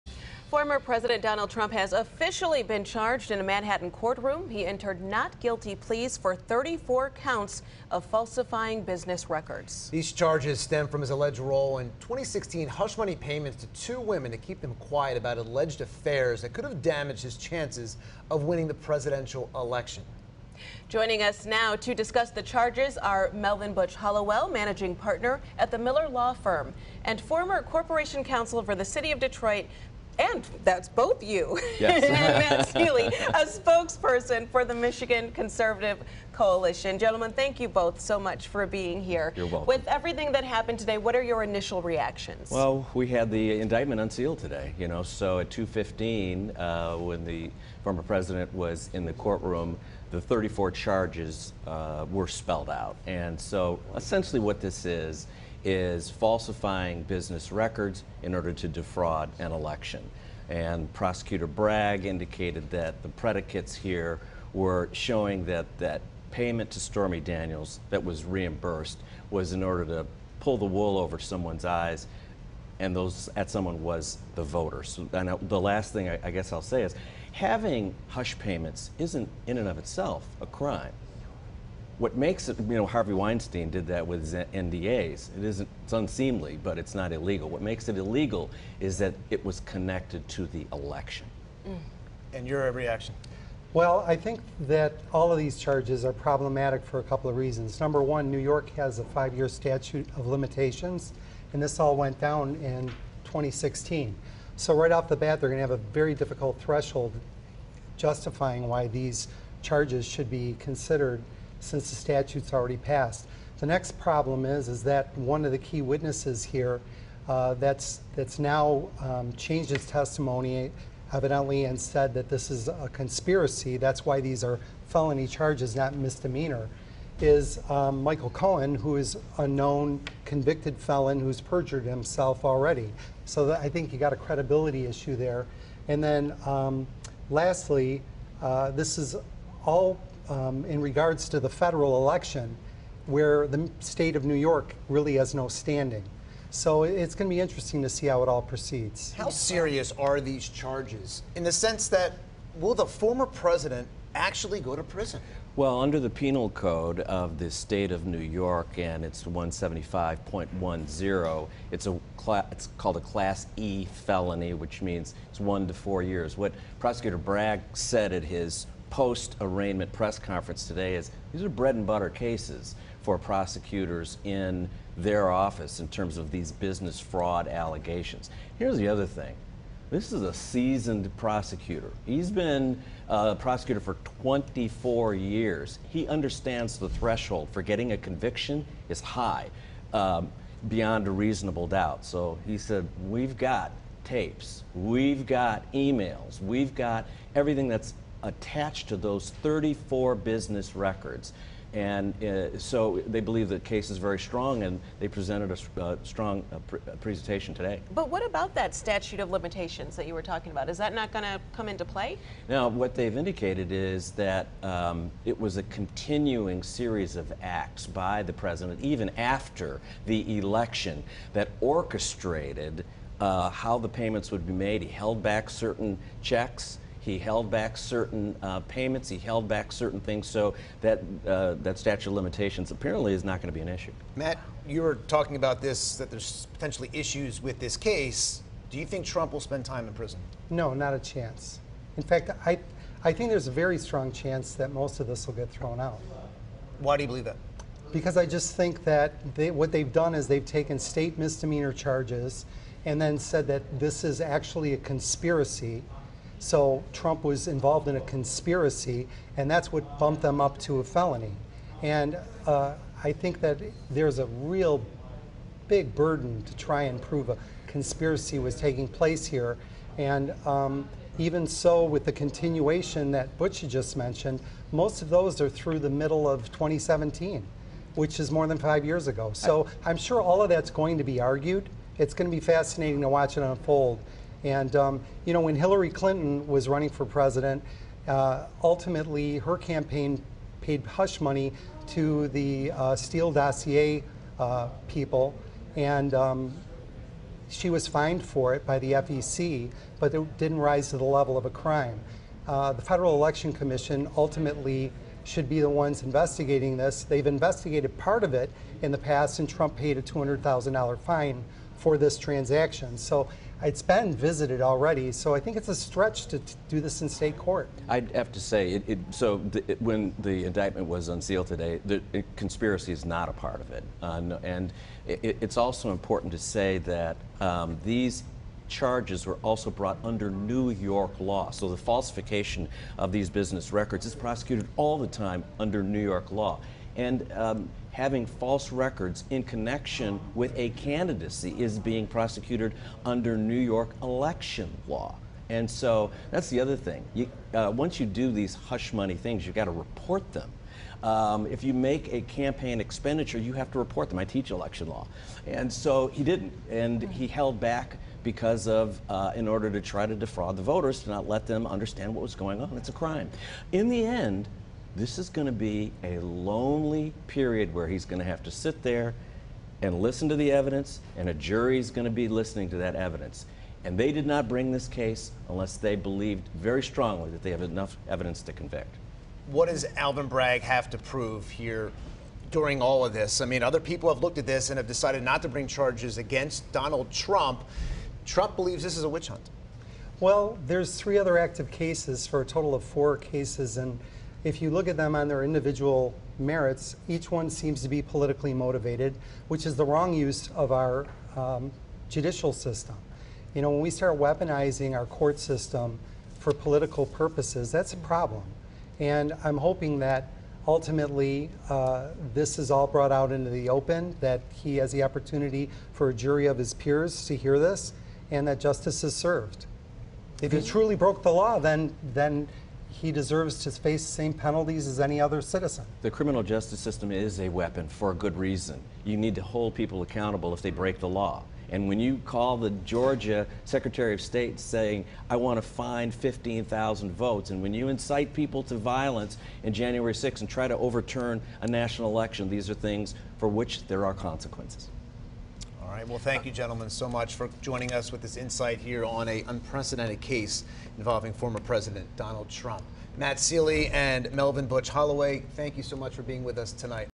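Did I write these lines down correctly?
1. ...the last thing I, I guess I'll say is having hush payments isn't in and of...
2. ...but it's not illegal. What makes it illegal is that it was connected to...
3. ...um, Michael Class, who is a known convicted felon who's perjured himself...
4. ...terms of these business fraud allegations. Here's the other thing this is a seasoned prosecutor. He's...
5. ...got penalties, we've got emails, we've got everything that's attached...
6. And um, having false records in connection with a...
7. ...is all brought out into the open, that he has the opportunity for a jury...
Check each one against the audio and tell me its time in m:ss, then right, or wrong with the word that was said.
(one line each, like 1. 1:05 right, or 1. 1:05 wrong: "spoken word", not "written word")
1. 1:15 right
2. 1:26 right
3. 2:07 wrong: "Cohen", not "Class"
4. 2:55 right
5. 3:13 wrong: "tapes", not "penalties"
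6. 5:36 right
7. 6:52 right.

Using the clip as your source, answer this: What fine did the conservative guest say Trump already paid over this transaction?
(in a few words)
$200,000.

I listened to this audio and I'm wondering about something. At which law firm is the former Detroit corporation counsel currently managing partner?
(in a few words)
Miller Law Firm.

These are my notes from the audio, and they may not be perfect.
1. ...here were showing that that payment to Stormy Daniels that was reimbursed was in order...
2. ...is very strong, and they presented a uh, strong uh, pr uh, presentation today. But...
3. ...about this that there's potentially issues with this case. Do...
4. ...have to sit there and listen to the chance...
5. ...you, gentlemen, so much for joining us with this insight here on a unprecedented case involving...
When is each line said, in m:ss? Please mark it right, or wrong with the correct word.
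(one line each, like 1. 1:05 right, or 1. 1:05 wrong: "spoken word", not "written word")
1. 1:03 right
2. 3:23 right
3. 3:55 right
4. 6:08 wrong: "evidence", not "chance"
5. 7:26 right.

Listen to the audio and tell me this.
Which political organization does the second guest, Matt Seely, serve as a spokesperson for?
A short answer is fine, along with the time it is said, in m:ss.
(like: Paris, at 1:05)
Michigan Conservative Coalition, at 0:34.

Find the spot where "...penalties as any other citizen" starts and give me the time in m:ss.
7:04.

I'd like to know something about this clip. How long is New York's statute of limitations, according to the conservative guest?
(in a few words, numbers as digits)
5 years.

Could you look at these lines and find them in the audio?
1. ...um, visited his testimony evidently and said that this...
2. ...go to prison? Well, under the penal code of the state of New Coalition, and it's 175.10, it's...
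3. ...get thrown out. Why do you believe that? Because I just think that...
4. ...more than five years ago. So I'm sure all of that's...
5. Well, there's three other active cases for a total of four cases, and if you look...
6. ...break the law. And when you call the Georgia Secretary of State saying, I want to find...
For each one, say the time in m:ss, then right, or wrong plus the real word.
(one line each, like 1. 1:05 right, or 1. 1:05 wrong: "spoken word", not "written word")
1. 1:58 wrong: "changed", not "visited"
2. 2:34 wrong: "York", not "Coalition"
3. 4:05 right
4. 4:38 right
5. 6:30 right
6. 7:10 right.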